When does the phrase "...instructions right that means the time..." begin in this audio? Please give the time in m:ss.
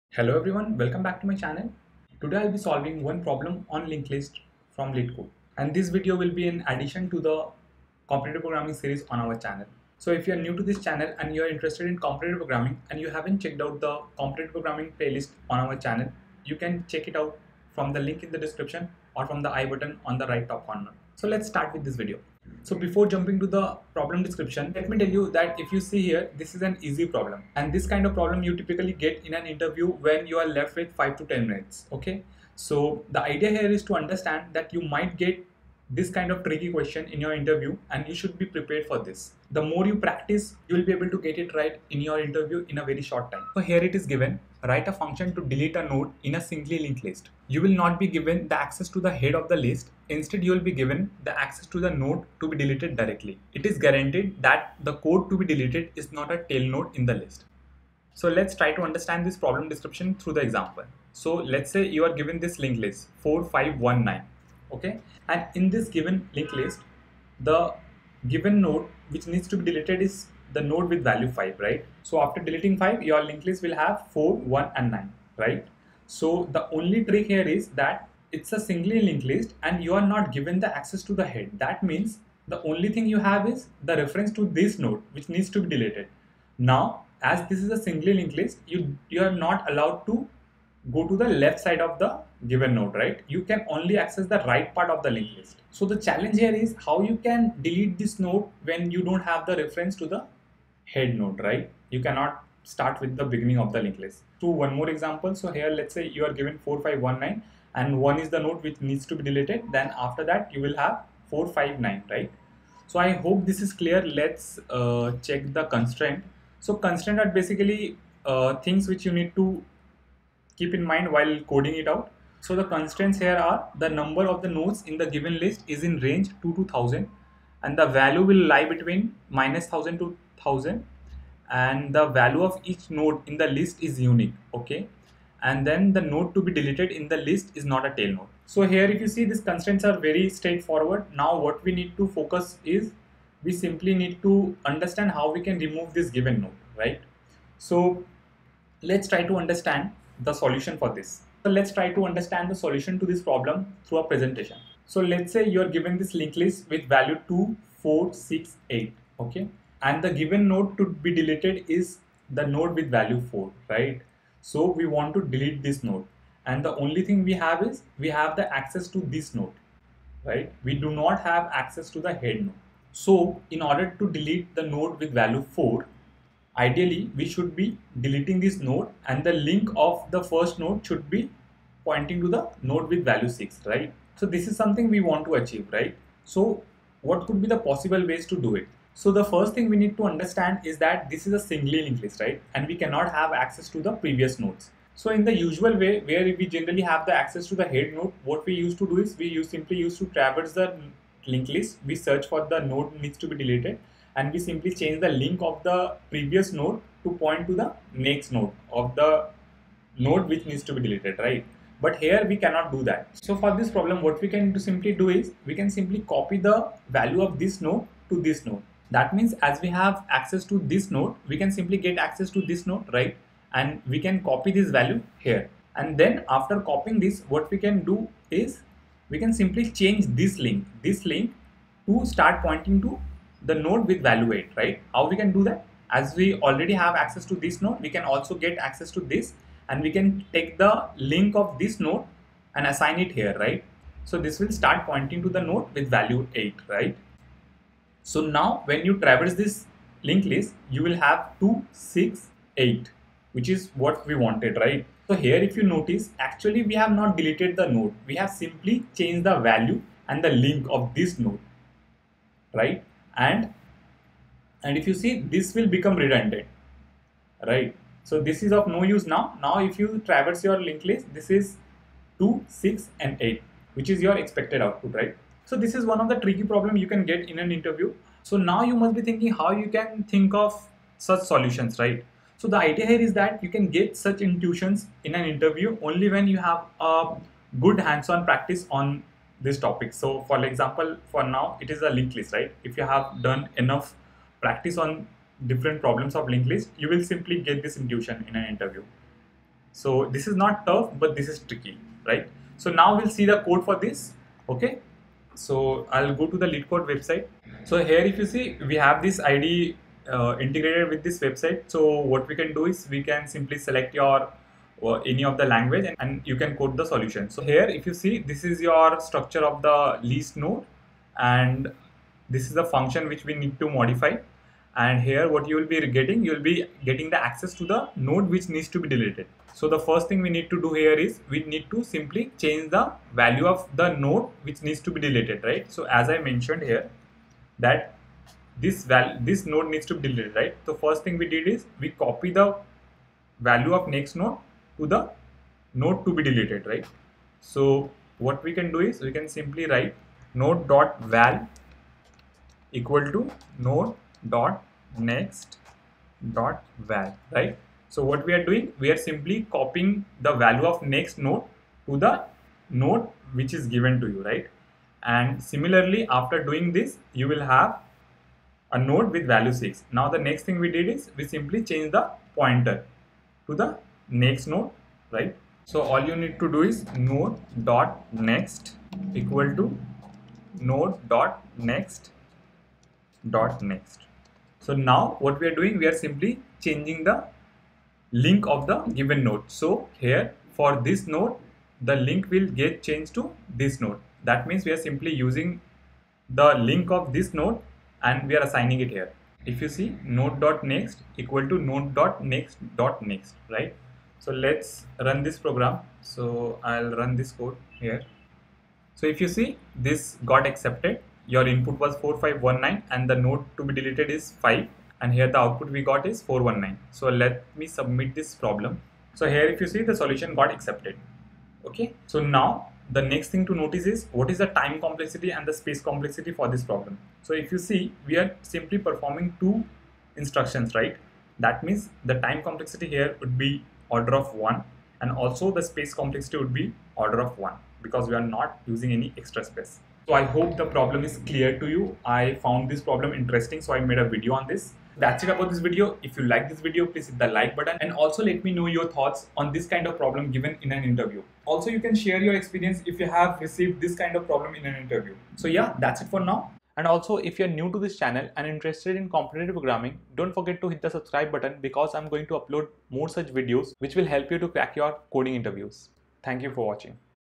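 7:10.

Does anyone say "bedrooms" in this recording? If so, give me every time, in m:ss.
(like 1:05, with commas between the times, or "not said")
not said.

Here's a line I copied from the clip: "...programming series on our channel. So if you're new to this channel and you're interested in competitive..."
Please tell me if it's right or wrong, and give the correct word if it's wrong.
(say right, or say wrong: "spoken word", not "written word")
right.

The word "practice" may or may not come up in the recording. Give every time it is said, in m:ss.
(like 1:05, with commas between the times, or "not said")
0:39, 4:48, 4:54.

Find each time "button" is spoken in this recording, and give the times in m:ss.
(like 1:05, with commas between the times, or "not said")
0:19, 7:27, 7:41.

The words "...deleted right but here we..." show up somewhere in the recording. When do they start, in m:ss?
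3:30.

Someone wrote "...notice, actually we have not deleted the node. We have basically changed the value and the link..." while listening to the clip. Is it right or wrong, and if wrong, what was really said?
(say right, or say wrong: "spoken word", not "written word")
wrong: "simply", not "basically".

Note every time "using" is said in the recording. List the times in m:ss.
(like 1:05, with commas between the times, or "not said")
6:35, 7:18.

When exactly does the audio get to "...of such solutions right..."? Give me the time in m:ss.
4:40.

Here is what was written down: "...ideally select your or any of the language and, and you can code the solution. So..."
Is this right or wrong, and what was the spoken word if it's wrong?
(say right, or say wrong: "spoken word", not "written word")
wrong: "simply", not "ideally".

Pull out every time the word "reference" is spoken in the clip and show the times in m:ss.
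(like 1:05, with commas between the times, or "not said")
1:24, 1:39.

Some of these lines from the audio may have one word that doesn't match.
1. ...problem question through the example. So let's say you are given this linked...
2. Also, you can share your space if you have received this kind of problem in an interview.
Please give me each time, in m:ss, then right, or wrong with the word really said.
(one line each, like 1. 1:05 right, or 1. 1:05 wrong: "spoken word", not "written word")
1. 0:59 wrong: "description", not "question"
2. 7:31 wrong: "experience", not "space".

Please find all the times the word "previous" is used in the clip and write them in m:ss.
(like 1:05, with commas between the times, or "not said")
3:13, 3:26.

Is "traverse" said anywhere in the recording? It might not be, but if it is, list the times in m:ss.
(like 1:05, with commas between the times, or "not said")
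3:20, 4:08, 4:30.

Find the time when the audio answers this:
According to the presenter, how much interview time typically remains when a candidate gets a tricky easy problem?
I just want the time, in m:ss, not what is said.
0:30.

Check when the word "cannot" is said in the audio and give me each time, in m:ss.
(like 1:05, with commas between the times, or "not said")
1:42, 3:12, 3:32.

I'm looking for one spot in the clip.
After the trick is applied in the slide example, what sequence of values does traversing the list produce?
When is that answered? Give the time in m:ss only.
4:11.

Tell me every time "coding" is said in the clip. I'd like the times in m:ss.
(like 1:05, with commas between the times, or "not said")
2:01, 7:45.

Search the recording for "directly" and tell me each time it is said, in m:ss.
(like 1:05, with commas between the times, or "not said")
0:52.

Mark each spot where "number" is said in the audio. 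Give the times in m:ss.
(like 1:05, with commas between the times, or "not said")
2:03.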